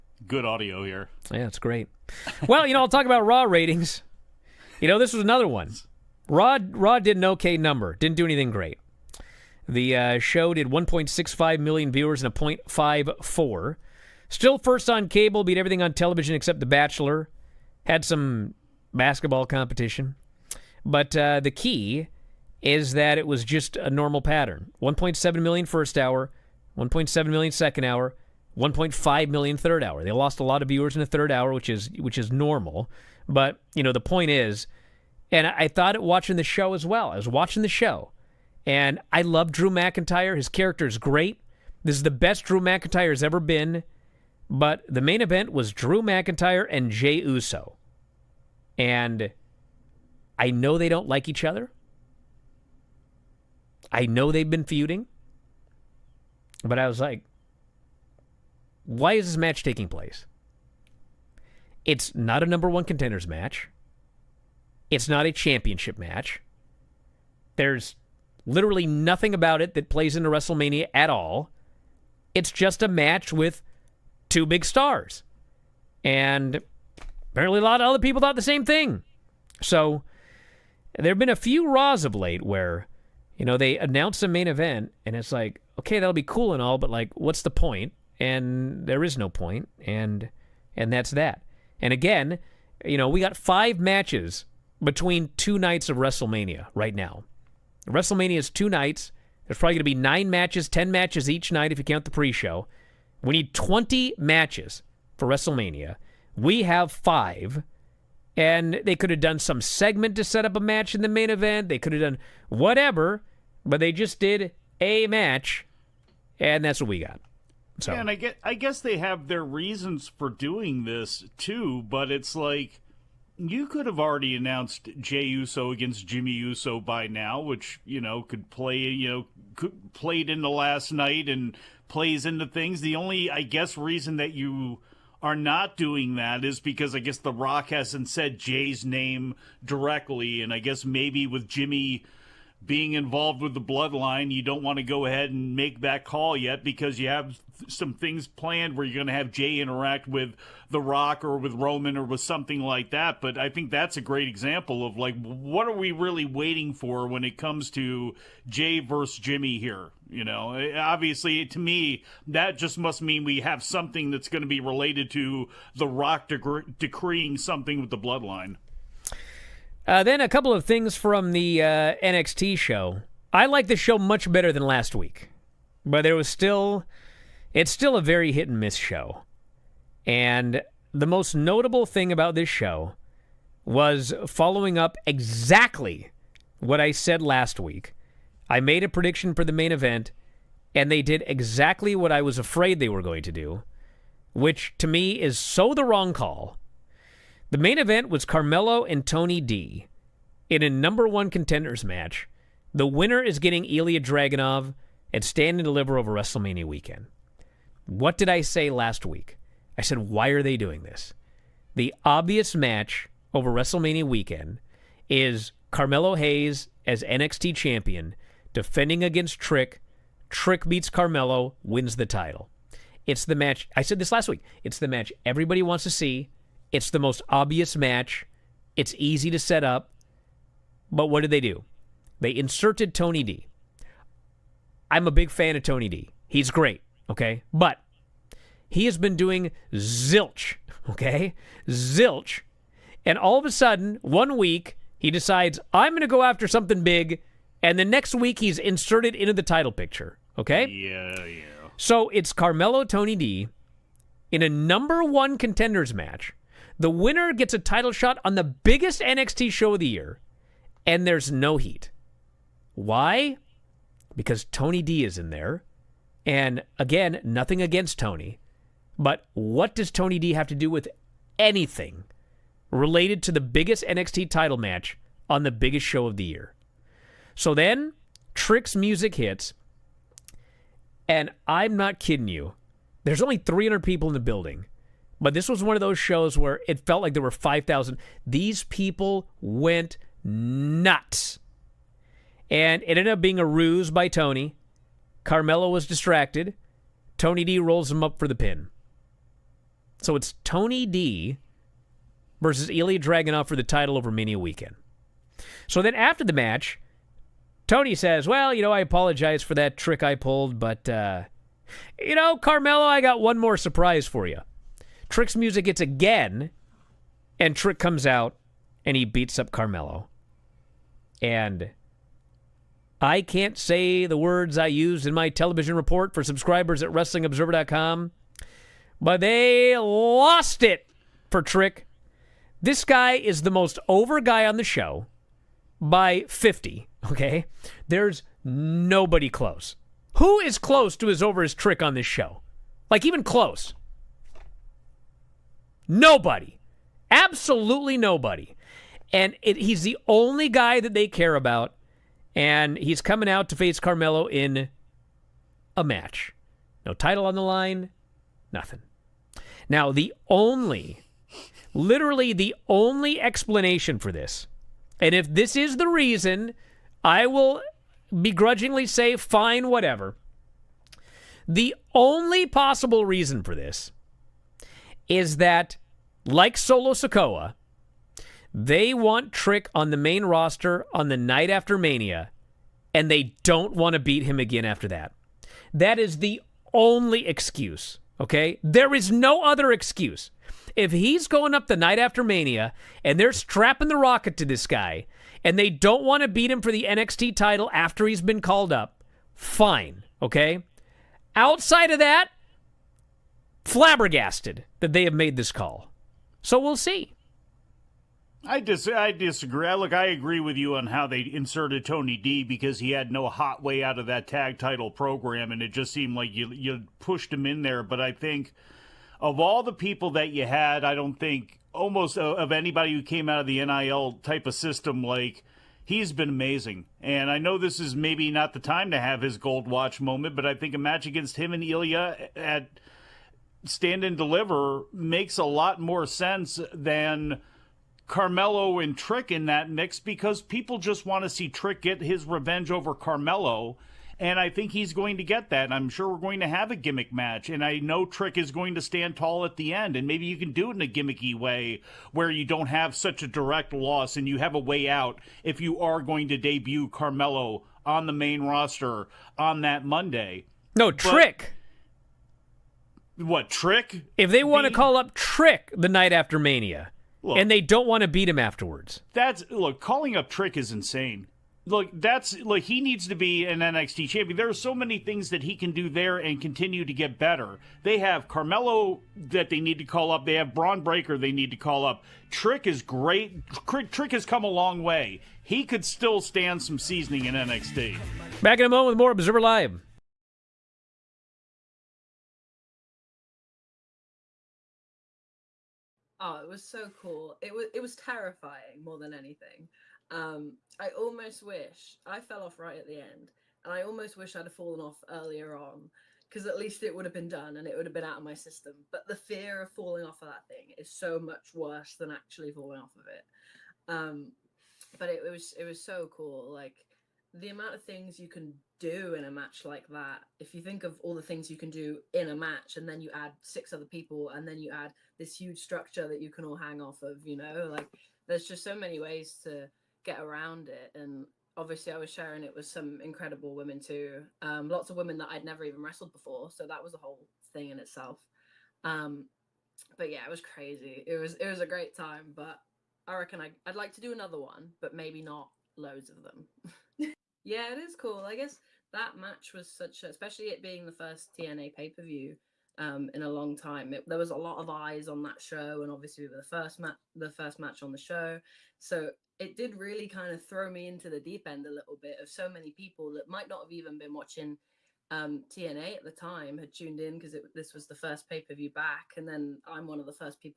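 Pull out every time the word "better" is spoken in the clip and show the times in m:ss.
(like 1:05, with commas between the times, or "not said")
2:54, 7:57.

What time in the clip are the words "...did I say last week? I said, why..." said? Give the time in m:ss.
3:28.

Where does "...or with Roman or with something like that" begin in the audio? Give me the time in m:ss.
2:31.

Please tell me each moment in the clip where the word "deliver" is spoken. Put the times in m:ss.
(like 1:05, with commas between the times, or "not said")
3:25, 7:14.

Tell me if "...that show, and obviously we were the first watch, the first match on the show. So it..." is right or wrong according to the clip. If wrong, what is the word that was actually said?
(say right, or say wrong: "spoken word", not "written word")
wrong: "match", not "watch".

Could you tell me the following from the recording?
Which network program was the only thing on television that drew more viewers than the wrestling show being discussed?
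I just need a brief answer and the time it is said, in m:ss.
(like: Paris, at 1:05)
The Bachelor, at 0:16.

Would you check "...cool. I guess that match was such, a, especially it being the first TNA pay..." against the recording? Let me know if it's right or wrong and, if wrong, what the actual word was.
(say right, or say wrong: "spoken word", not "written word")
right.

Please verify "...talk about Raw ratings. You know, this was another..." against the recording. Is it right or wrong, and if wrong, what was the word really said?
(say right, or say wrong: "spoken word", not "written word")
right.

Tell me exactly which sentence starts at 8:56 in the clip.
So that was a whole thing in itself.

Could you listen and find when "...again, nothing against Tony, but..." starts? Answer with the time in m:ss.
4:26.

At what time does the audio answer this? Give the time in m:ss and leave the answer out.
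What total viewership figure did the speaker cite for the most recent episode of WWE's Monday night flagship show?
0:10.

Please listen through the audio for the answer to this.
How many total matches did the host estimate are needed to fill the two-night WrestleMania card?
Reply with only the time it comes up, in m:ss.
1:43.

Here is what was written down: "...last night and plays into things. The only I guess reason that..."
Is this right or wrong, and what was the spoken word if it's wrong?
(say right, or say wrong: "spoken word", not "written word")
right.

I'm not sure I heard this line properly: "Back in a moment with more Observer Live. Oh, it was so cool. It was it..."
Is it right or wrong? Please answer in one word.
right.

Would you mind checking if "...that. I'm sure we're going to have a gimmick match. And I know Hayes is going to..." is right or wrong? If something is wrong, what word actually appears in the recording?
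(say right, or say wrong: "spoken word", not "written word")
wrong: "Trick", not "Hayes".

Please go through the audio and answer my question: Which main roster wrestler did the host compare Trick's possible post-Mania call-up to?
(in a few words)
Solo Sikoa.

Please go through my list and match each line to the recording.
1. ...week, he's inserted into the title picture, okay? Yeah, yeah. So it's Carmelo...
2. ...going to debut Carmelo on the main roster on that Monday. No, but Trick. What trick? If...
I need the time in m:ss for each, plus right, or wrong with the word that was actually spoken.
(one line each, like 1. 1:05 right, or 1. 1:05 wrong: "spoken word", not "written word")
1. 4:08 right
2. 7:36 right.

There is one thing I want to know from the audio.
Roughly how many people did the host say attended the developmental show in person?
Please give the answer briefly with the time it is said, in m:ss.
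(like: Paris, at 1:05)
300, at 4:43.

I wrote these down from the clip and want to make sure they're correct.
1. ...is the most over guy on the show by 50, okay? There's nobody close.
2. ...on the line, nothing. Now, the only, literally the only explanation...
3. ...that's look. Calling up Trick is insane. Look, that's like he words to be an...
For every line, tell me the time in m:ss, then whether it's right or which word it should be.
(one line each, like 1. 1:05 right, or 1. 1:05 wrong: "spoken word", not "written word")
1. 5:33 right
2. 5:57 right
3. 7:49 wrong: "needs", not "words".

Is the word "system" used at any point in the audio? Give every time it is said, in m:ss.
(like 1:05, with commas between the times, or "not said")
7:04, 8:28.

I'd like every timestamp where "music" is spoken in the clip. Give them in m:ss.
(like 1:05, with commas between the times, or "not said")
4:38, 5:15.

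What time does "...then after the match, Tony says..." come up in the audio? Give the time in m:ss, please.
5:05.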